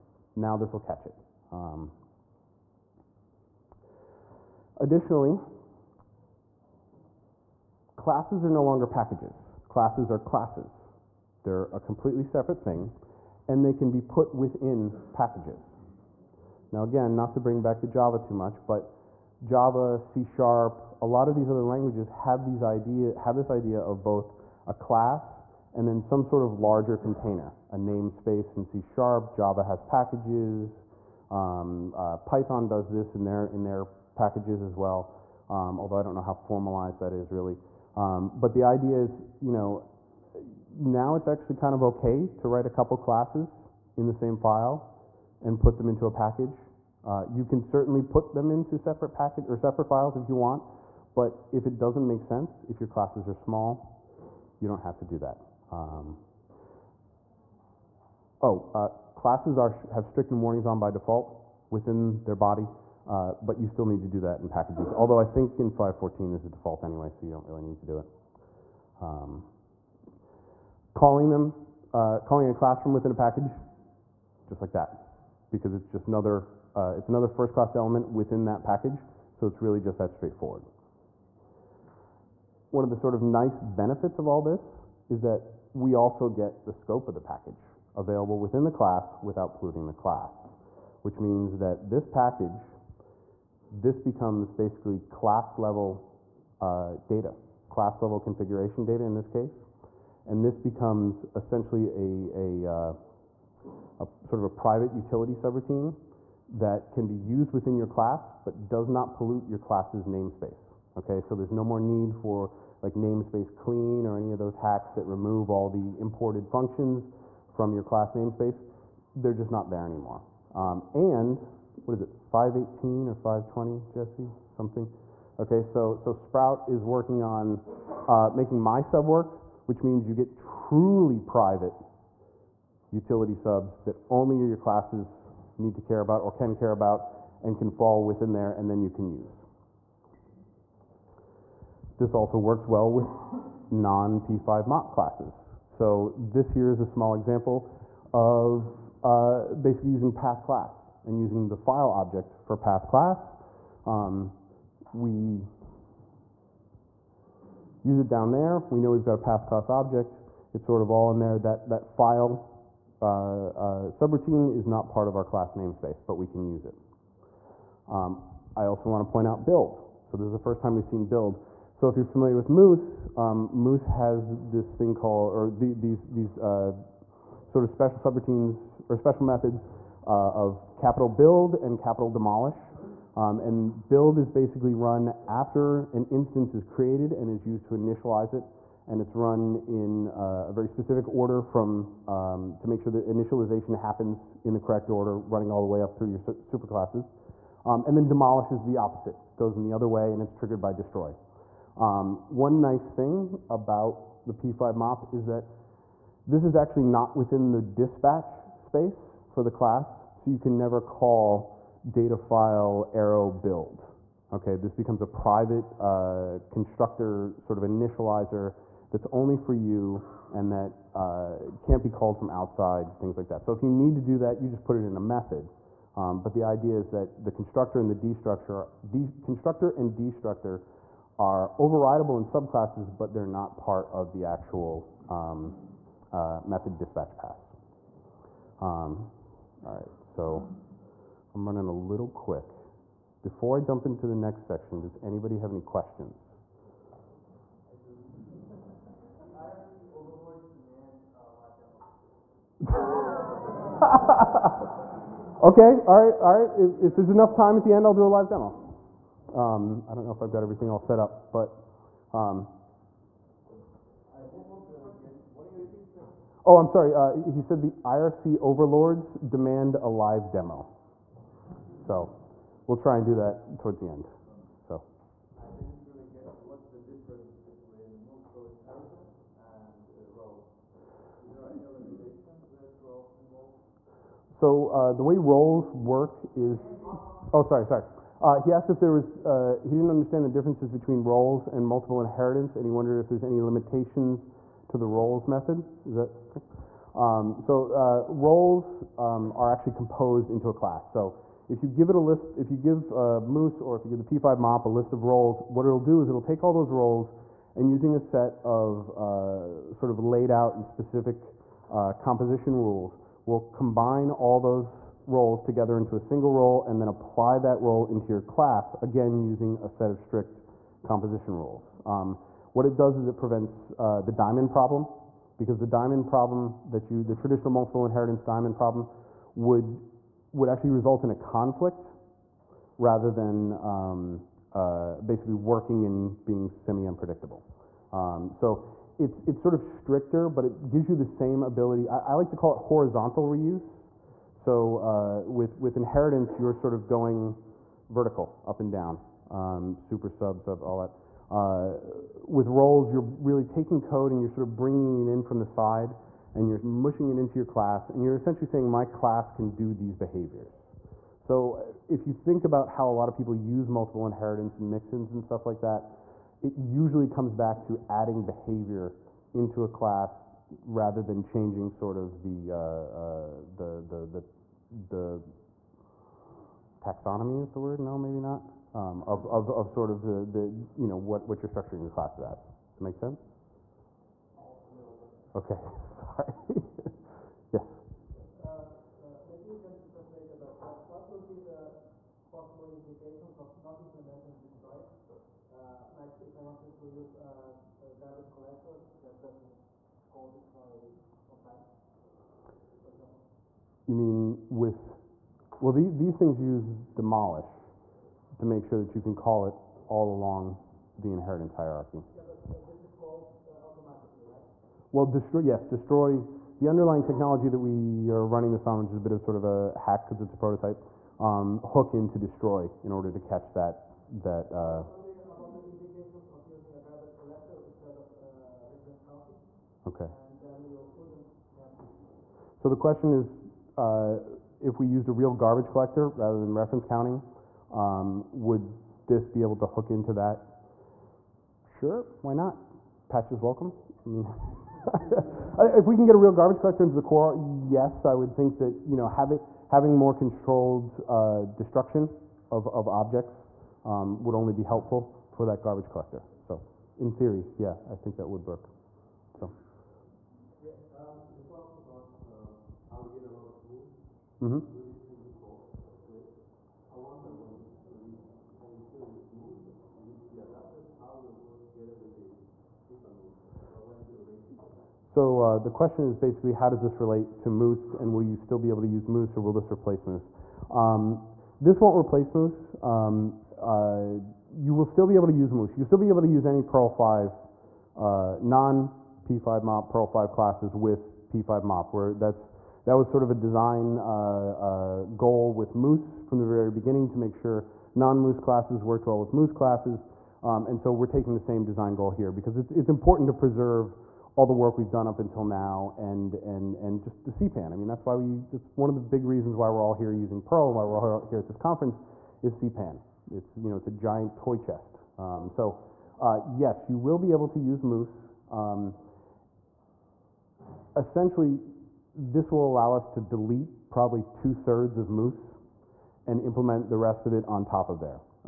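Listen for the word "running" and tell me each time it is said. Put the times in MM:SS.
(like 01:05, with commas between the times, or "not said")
03:15, 04:01, 06:58.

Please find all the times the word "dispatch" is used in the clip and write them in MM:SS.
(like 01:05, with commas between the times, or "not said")
03:27, 03:56.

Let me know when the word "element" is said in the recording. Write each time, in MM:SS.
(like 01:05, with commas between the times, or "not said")
01:17.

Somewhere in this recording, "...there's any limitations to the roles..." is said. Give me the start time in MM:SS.
04:53.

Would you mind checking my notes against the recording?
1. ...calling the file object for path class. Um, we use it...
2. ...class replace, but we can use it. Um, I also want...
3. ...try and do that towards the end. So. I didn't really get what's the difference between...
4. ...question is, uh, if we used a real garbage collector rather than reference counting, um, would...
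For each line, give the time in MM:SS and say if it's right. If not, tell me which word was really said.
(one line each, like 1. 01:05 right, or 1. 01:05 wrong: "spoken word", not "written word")
1. 02:31 wrong: "using", not "calling"
2. 02:45 wrong: "namespace", not "replace"
3. 04:32 right
4. 07:12 right.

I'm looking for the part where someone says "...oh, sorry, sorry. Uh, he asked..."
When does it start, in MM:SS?
04:47.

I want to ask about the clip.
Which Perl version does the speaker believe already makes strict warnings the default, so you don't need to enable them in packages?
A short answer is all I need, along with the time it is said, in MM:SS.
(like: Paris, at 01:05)
5.14, at 01:05.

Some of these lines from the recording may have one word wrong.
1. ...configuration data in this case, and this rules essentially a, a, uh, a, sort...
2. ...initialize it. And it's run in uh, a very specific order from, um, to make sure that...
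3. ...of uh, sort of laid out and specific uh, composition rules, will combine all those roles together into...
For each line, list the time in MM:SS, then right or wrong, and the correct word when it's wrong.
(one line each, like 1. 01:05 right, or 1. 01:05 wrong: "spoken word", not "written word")
1. 01:38 wrong: "becomes", not "rules"
2. 03:07 right
3. 05:08 right.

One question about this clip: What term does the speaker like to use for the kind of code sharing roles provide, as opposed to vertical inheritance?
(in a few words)
horizontal reuse.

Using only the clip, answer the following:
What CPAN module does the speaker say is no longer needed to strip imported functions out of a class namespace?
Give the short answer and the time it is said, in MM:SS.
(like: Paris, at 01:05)
namespace clean, at 01:52.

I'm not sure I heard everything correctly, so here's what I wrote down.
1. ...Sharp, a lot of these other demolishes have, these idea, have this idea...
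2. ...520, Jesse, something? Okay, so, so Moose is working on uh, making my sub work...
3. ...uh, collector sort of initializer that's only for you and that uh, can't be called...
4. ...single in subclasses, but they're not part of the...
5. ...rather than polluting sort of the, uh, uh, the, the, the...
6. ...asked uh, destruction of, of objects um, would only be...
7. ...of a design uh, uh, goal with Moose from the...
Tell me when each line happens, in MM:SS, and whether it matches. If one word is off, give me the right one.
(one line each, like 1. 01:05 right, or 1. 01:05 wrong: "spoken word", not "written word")
1. 00:20 wrong: "languages", not "demolishes"
2. 02:03 wrong: "Sprout", not "Moose"
3. 03:35 wrong: "constructor", not "collector"
4. 03:51 wrong: "overridable", not "single"
5. 06:10 wrong: "changing", not "polluting"
6. 07:30 wrong: "controlled", not "asked"
7. 08:13 right.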